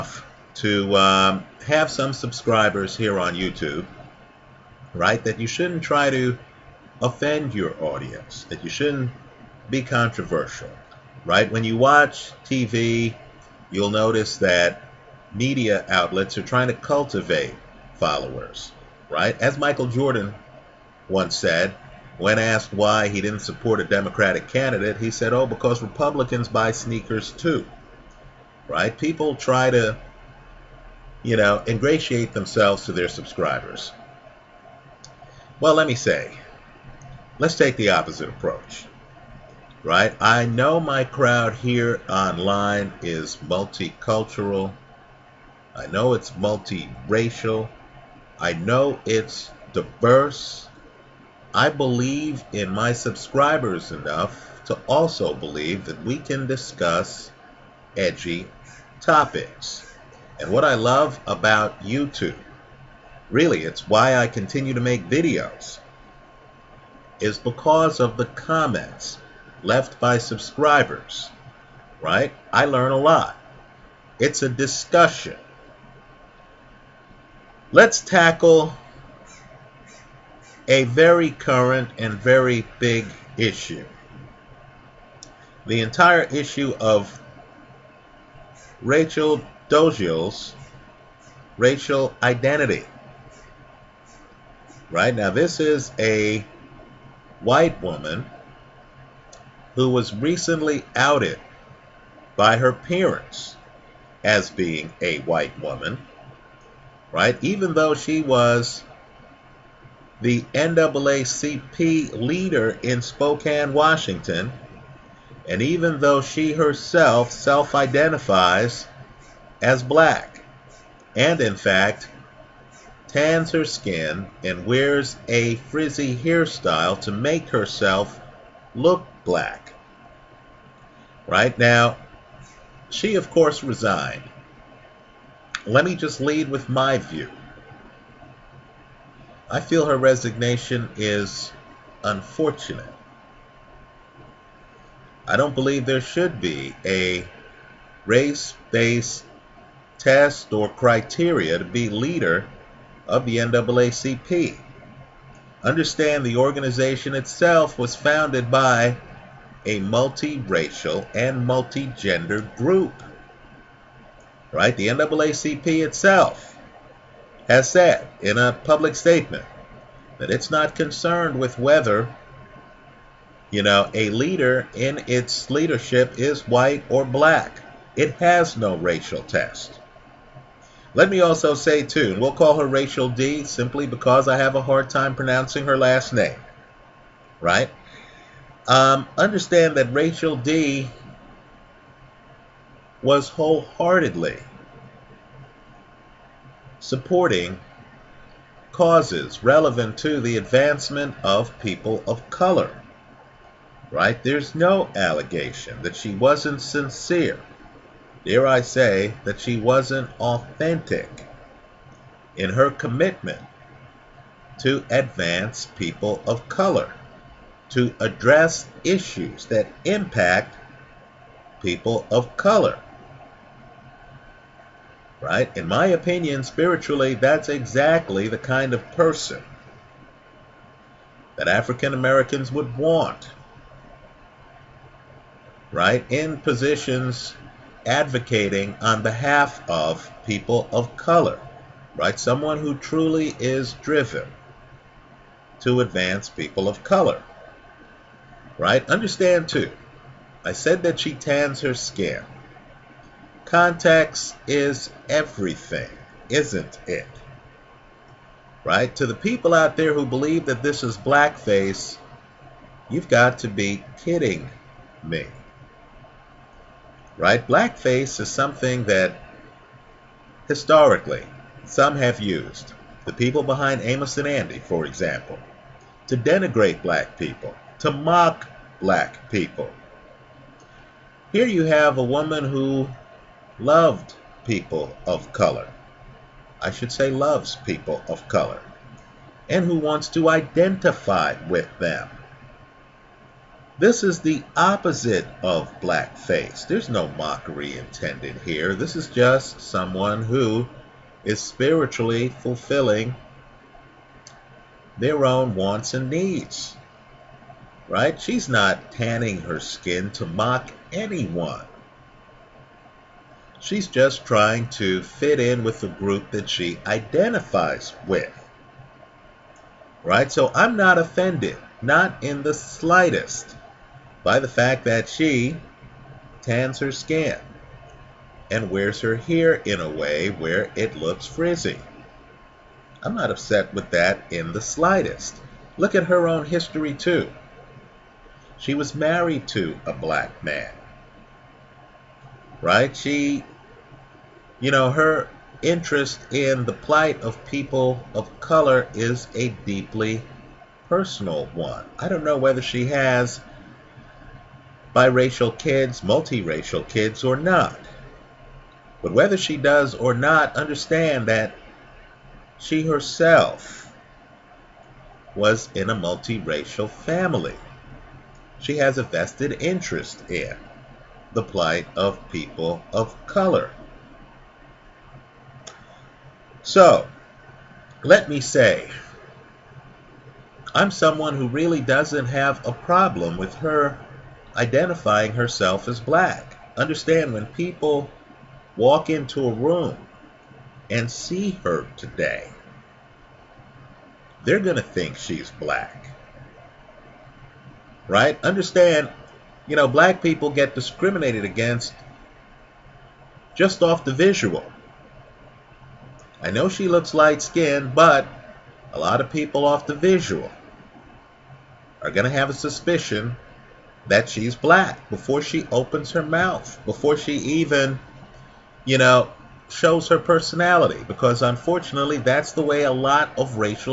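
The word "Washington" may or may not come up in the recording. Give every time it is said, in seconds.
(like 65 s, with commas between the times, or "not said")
113 s.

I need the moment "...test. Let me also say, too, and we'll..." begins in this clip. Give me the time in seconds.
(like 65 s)
179 s.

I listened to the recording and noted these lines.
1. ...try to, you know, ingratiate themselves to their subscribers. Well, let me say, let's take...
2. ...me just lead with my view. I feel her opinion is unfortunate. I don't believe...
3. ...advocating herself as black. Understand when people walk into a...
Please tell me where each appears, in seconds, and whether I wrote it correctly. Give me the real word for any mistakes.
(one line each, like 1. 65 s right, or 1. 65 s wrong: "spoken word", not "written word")
1. 29 s right
2. 135 s wrong: "resignation", not "opinion"
3. 384 s wrong: "identifying", not "advocating".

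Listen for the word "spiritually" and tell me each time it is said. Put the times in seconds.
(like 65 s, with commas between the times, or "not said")
226 s, 301 s.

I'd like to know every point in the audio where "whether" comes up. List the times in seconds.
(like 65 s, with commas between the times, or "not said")
171 s, 352 s, 359 s.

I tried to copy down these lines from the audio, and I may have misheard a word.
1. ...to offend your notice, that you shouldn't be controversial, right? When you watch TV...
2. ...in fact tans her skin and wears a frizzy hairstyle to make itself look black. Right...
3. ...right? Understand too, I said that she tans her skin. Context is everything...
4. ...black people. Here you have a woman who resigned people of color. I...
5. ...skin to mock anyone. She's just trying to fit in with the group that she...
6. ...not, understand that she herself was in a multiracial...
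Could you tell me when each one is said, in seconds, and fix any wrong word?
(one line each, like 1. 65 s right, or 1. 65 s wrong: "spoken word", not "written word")
1. 6 s wrong: "audience", not "notice"
2. 121 s wrong: "herself", not "itself"
3. 248 s right
4. 278 s wrong: "loved", not "resigned"
5. 309 s right
6. 360 s right.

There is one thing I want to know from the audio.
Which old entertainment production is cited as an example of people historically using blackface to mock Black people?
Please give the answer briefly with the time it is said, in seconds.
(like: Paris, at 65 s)
Amos and Andy, at 273 s.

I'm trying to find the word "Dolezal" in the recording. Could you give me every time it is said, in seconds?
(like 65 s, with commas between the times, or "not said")
89 s.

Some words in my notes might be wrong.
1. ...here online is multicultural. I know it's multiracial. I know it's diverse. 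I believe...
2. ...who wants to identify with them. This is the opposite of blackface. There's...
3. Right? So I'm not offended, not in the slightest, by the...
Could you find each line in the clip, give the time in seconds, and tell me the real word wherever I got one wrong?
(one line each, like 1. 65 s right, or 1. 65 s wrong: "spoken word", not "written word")
1. 41 s right
2. 289 s right
3. 320 s right.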